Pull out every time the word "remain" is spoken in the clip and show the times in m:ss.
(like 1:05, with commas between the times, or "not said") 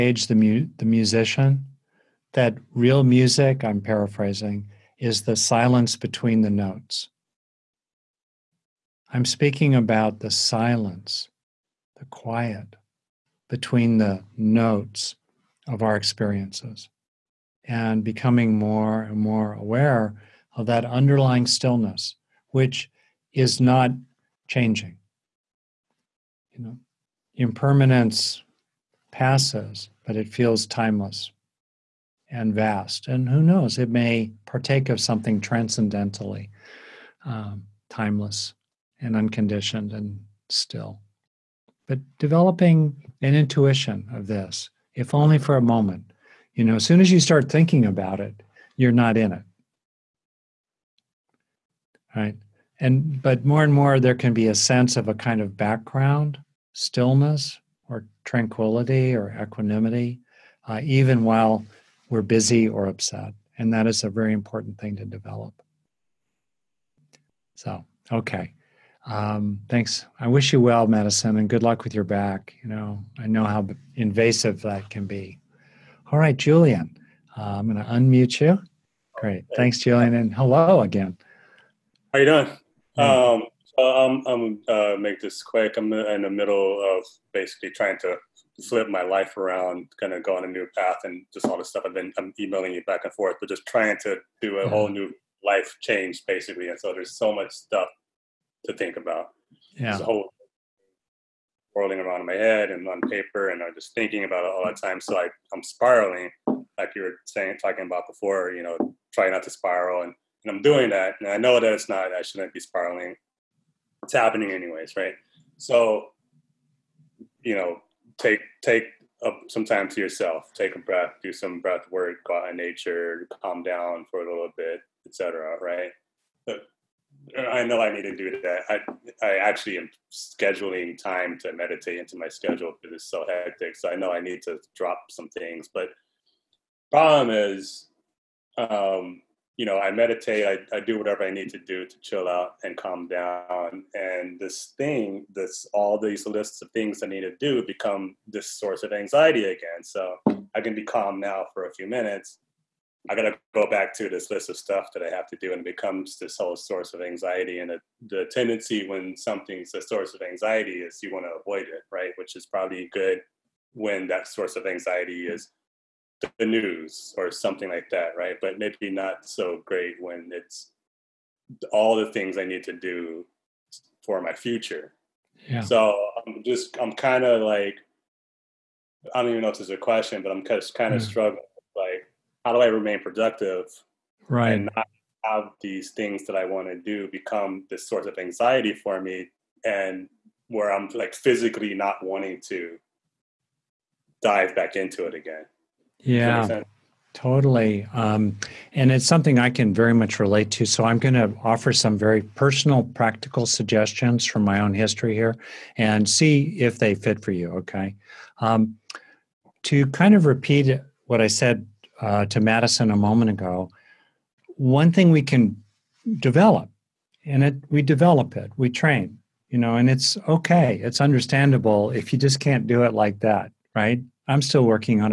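3:02.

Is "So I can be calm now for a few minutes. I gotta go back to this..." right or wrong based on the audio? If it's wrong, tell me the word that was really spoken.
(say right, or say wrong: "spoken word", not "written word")
right.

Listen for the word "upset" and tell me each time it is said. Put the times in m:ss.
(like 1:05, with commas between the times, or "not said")
1:02.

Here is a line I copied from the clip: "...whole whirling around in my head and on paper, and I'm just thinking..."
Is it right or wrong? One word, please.
right.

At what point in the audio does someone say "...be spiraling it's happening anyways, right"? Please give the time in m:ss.
1:52.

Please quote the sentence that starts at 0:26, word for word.
You know, impermanence passes, but it feels timeless and vast.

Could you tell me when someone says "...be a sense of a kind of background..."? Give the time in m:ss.
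0:54.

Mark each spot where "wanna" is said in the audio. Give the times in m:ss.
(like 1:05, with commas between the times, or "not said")
2:41.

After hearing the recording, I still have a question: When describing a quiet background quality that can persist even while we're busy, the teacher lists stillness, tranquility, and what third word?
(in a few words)
equanimity.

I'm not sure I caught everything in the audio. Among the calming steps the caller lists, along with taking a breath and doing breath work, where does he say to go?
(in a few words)
out in nature.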